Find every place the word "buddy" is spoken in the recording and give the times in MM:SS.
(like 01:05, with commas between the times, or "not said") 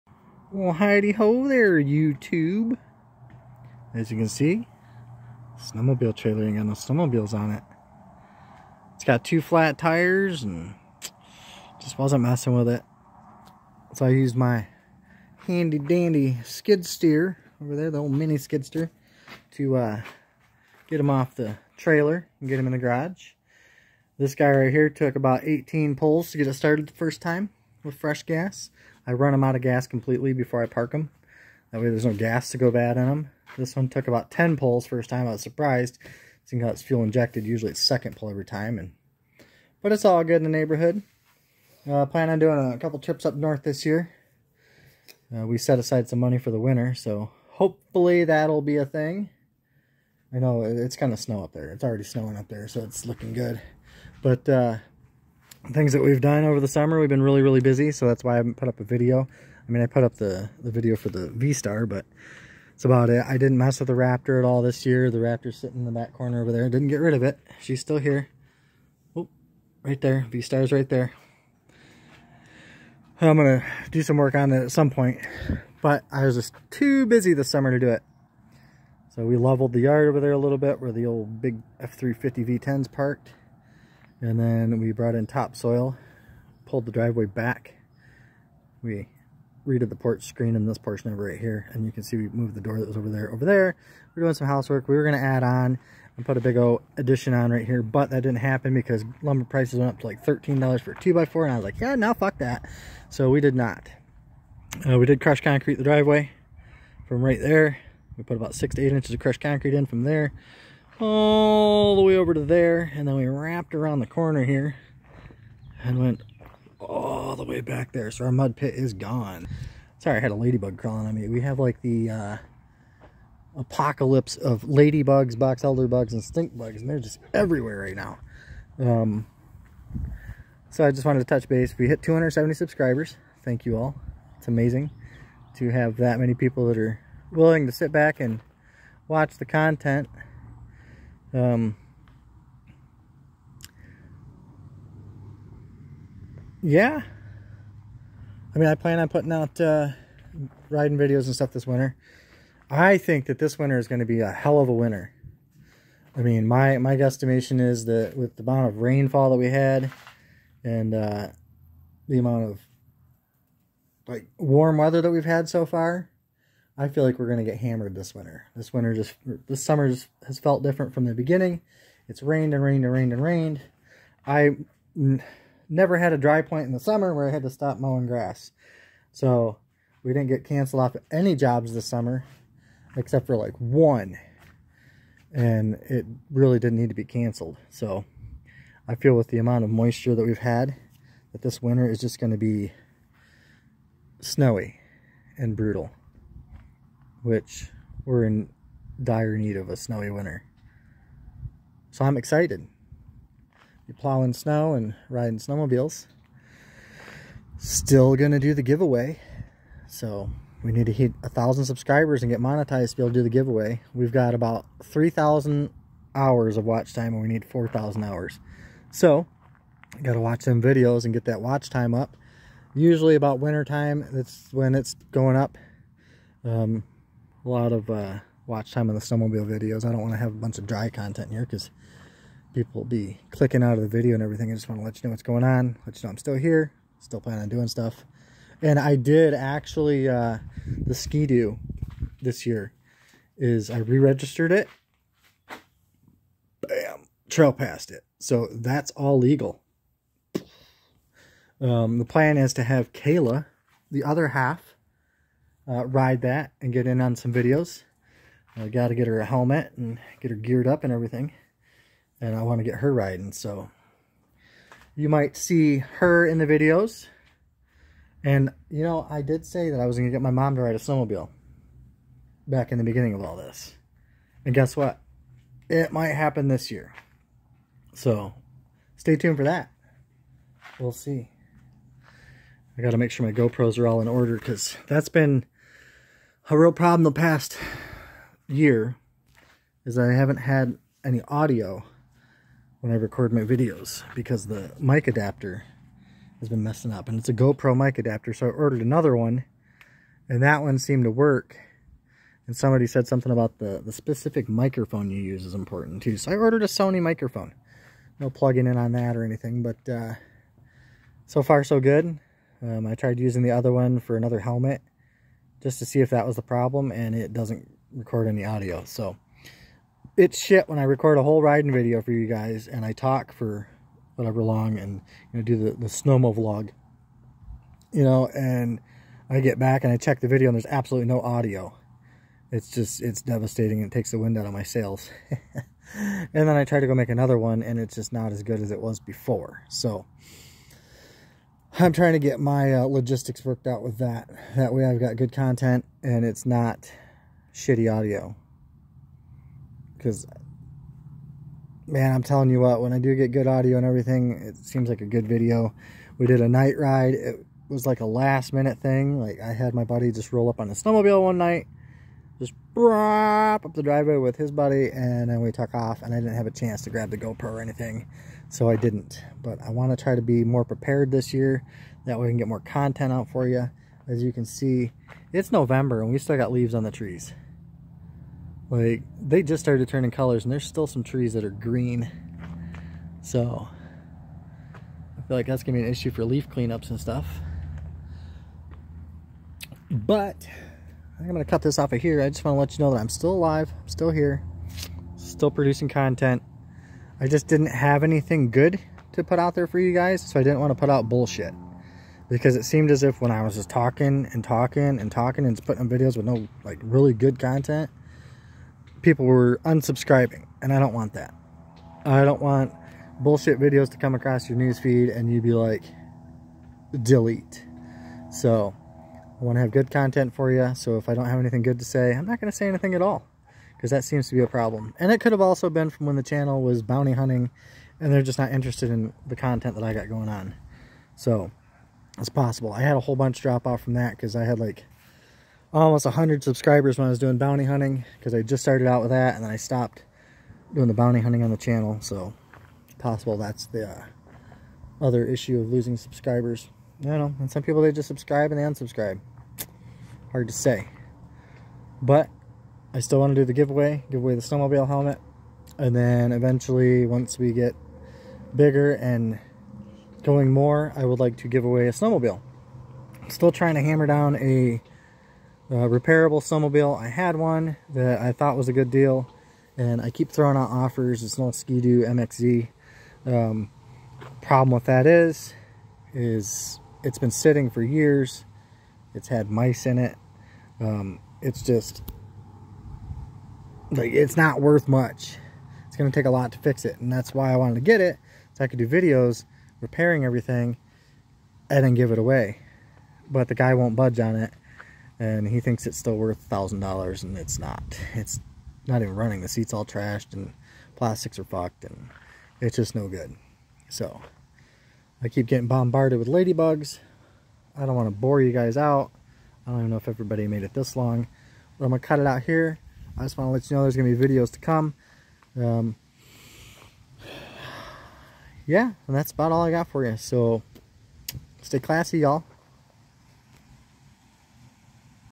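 05:59, 06:04.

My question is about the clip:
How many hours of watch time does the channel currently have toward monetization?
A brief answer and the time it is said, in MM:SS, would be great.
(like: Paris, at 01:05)
3,000, at 03:34.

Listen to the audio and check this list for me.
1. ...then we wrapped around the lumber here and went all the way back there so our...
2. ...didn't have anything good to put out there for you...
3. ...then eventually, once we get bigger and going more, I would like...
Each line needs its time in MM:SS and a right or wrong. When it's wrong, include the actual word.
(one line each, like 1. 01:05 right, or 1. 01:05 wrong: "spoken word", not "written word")
1. 01:53 wrong: "corner", not "lumber"
2. 06:37 right
3. 07:35 right.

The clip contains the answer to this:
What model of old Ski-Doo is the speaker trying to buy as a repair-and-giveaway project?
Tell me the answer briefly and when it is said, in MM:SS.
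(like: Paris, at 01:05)
MXZ, at 07:52.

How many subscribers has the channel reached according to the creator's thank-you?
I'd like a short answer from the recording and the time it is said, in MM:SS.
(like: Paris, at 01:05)
270, at 02:12.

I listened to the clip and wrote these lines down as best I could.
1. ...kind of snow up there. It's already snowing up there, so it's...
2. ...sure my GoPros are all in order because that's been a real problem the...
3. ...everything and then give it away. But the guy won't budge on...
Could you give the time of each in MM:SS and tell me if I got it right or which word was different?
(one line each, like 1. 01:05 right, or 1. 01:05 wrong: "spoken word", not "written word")
1. 00:50 right
2. 04:43 right
3. 08:10 right.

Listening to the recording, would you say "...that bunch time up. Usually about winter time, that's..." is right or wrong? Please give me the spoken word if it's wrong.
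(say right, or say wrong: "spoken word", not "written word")
wrong: "watch", not "bunch".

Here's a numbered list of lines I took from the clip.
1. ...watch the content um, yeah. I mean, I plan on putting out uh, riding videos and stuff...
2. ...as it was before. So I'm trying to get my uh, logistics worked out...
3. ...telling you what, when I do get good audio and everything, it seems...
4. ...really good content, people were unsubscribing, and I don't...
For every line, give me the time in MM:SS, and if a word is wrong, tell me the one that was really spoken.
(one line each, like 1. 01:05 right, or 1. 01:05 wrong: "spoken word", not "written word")
1. 02:19 right
2. 05:38 right
3. 05:52 right
4. 06:46 right.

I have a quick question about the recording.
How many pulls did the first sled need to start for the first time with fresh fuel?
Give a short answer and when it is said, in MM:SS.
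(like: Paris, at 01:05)
18, at 00:25.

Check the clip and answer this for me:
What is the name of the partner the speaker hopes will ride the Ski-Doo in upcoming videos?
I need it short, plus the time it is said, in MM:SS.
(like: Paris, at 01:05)
Kayla, at 04:12.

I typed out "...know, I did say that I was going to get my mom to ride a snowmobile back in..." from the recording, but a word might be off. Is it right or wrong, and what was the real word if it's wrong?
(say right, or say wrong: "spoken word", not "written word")
right.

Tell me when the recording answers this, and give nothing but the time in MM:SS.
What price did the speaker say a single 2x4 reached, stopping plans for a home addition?
01:40.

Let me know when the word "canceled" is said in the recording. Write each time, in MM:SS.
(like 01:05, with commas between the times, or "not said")
03:00, 03:07.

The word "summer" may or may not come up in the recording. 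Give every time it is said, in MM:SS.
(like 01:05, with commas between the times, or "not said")
00:56, 01:17, 02:49, 02:56, 03:01.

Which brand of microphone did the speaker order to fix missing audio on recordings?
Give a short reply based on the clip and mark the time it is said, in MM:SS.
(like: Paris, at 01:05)
Sony, at 05:06.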